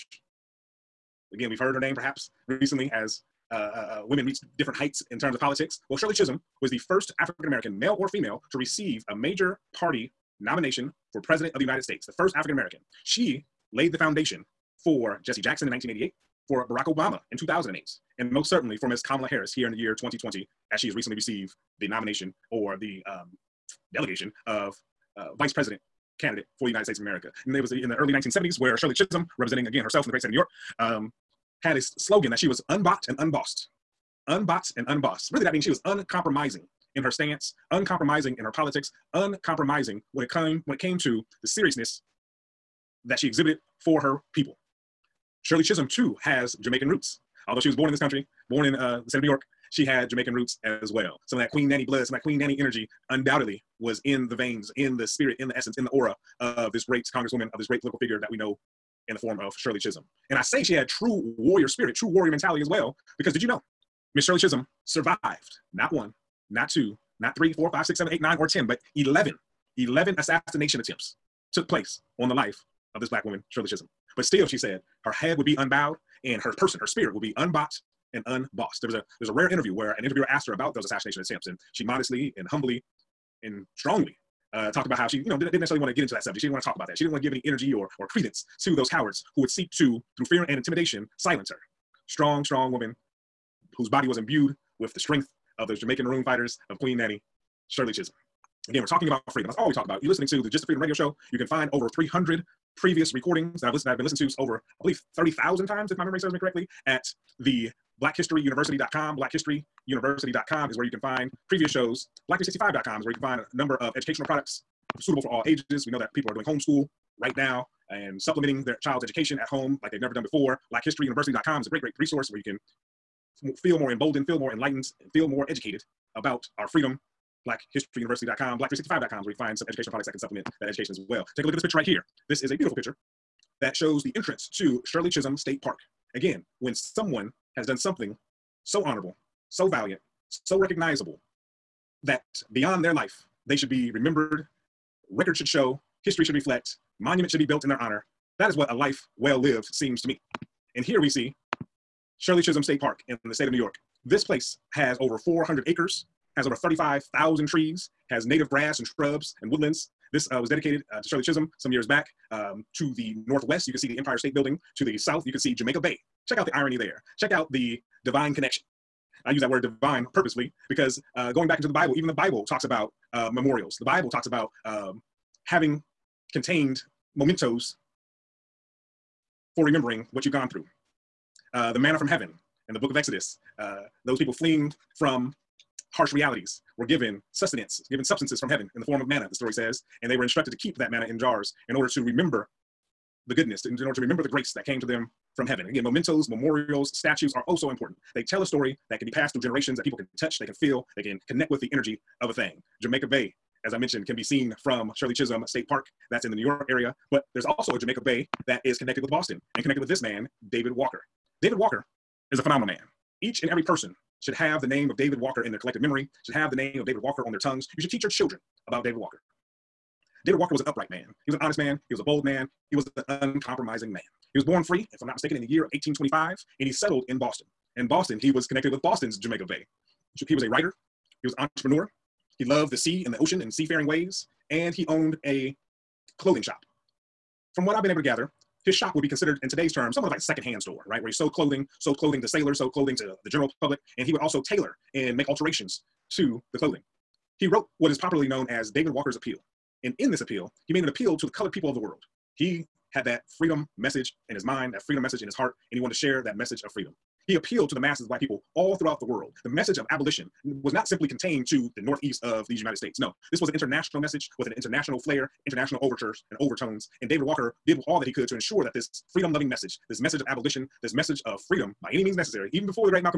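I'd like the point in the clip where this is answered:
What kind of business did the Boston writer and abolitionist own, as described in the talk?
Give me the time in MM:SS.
03:56.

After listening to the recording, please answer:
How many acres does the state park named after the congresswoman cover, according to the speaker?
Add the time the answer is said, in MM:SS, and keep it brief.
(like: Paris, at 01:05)
400, at 02:35.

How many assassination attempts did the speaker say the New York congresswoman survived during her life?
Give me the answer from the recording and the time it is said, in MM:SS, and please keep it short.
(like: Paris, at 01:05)
11, at 01:09.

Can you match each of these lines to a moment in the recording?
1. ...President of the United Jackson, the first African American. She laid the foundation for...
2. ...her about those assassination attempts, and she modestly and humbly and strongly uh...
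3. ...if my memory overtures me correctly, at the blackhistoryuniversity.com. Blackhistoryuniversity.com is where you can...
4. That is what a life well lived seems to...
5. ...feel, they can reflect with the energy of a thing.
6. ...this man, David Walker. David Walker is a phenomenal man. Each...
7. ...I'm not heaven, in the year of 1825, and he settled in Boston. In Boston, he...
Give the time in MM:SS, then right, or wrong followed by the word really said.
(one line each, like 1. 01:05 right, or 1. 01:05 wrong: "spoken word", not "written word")
1. 00:11 wrong: "States", not "Jackson"
2. 01:20 right
3. 01:45 wrong: "serves", not "overtures"
4. 02:28 right
5. 03:20 wrong: "connect", not "reflect"
6. 03:29 right
7. 03:45 wrong: "mistaken", not "heaven".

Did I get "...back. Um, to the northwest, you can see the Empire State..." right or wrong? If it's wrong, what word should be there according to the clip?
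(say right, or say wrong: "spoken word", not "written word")
right.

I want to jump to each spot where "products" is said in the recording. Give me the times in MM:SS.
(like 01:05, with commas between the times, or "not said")
01:54, 02:09.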